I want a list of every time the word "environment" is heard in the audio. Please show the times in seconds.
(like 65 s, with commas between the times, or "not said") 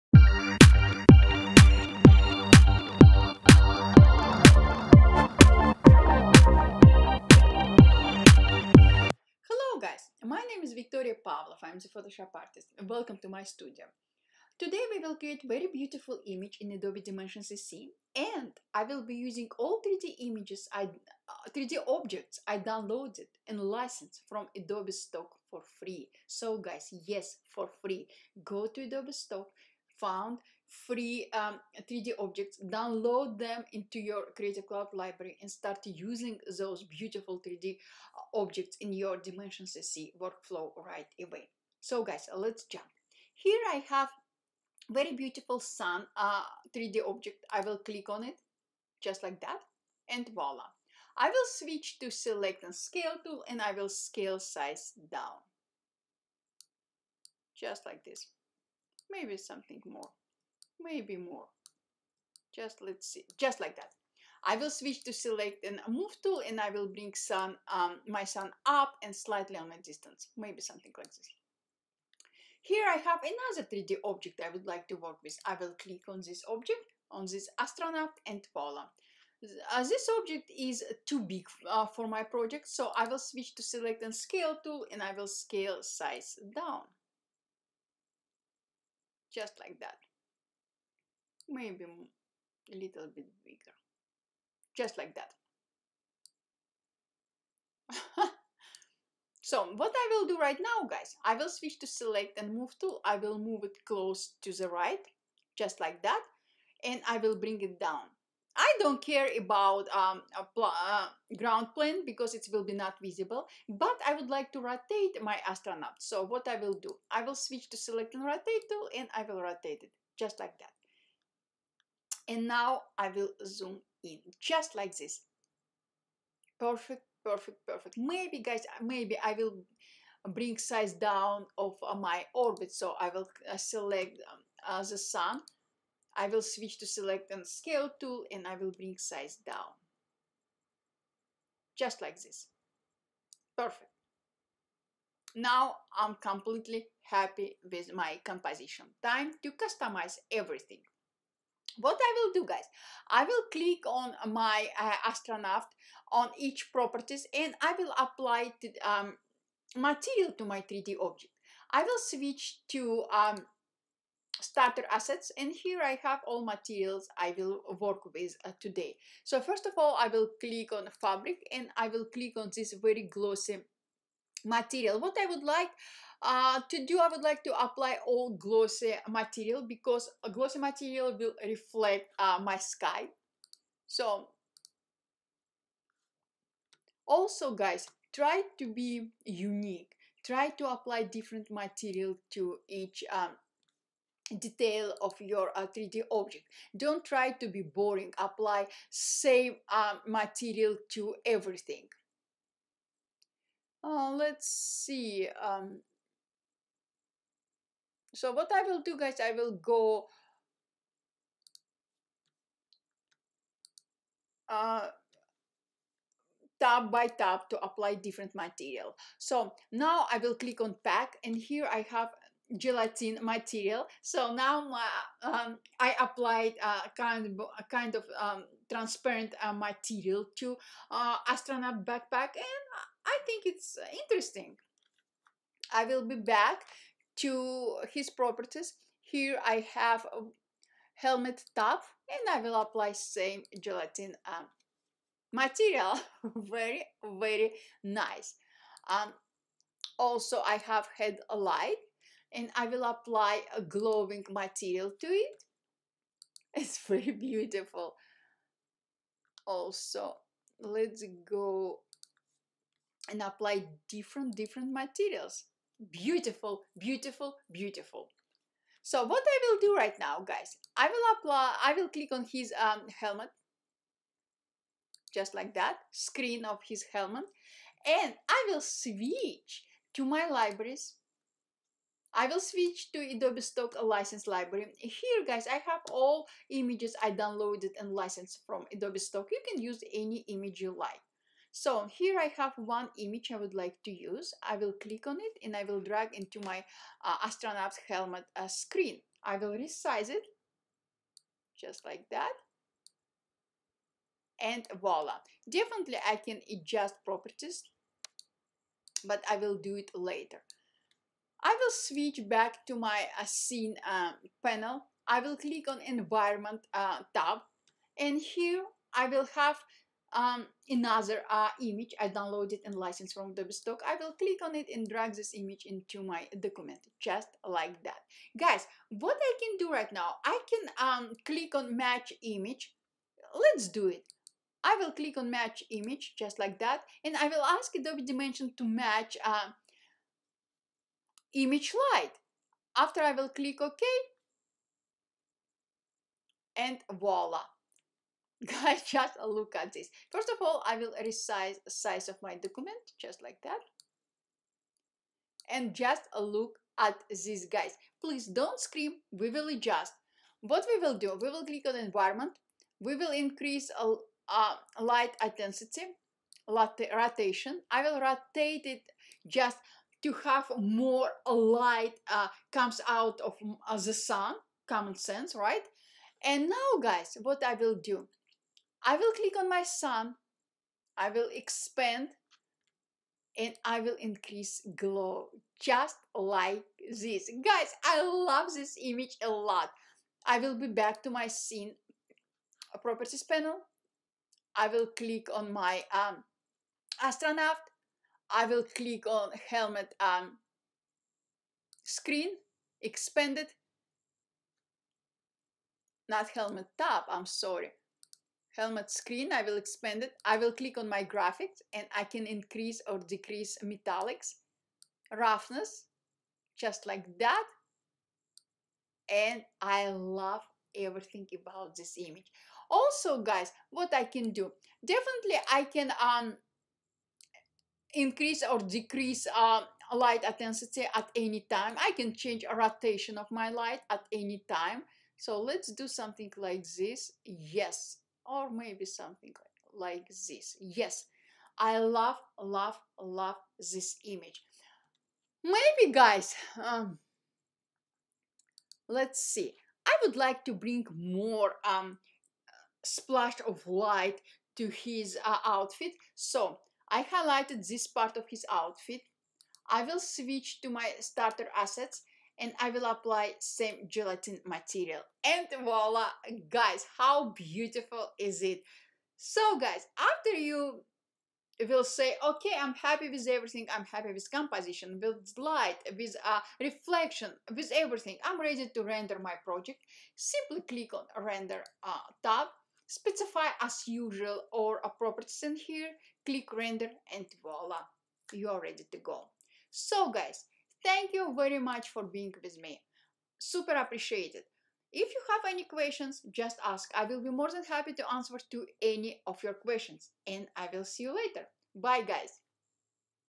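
315 s, 361 s.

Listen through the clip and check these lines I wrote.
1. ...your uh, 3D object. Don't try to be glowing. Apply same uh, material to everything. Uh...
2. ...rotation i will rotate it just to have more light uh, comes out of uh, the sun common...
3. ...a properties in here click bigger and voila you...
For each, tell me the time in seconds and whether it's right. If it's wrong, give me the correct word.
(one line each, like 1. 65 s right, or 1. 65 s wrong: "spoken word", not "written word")
1. 195 s wrong: "boring", not "glowing"
2. 366 s right
3. 484 s wrong: "render", not "bigger".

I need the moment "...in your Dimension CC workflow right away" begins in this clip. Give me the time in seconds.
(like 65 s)
38 s.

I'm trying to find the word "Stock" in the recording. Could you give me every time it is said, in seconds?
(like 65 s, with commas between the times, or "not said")
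24 s, 29 s, 283 s, 288 s, 323 s.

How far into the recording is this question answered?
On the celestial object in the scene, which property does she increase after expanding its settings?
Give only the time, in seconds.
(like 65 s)
384 s.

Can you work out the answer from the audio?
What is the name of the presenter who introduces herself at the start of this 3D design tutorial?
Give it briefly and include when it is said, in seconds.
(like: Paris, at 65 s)
Victoria Pavlov, at 11 s.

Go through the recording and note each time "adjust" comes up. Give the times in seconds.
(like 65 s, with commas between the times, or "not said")
306 s, 359 s.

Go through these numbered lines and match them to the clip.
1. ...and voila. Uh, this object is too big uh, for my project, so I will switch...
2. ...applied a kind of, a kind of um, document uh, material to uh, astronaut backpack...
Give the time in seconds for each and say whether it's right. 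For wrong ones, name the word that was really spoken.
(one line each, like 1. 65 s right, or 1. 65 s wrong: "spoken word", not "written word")
1. 78 s right
2. 225 s wrong: "transparent", not "document".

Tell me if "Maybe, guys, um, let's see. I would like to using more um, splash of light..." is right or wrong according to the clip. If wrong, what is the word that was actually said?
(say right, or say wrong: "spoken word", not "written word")
wrong: "bring", not "using".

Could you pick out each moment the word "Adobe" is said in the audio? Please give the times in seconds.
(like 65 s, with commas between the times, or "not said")
16 s, 24 s, 28 s, 282 s, 288 s, 323 s, 337 s.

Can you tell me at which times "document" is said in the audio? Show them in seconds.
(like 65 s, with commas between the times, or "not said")
326 s, 352 s.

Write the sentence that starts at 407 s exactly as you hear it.
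I'm sorry helmet screen, I will expand it.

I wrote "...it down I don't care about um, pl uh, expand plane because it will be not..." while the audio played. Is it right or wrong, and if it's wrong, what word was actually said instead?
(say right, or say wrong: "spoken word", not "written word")
wrong: "ground", not "expand".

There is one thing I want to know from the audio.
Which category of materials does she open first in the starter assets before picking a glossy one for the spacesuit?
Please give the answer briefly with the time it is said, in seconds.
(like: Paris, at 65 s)
fabric, at 170 s.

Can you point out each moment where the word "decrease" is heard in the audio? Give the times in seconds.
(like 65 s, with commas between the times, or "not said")
412 s, 428 s.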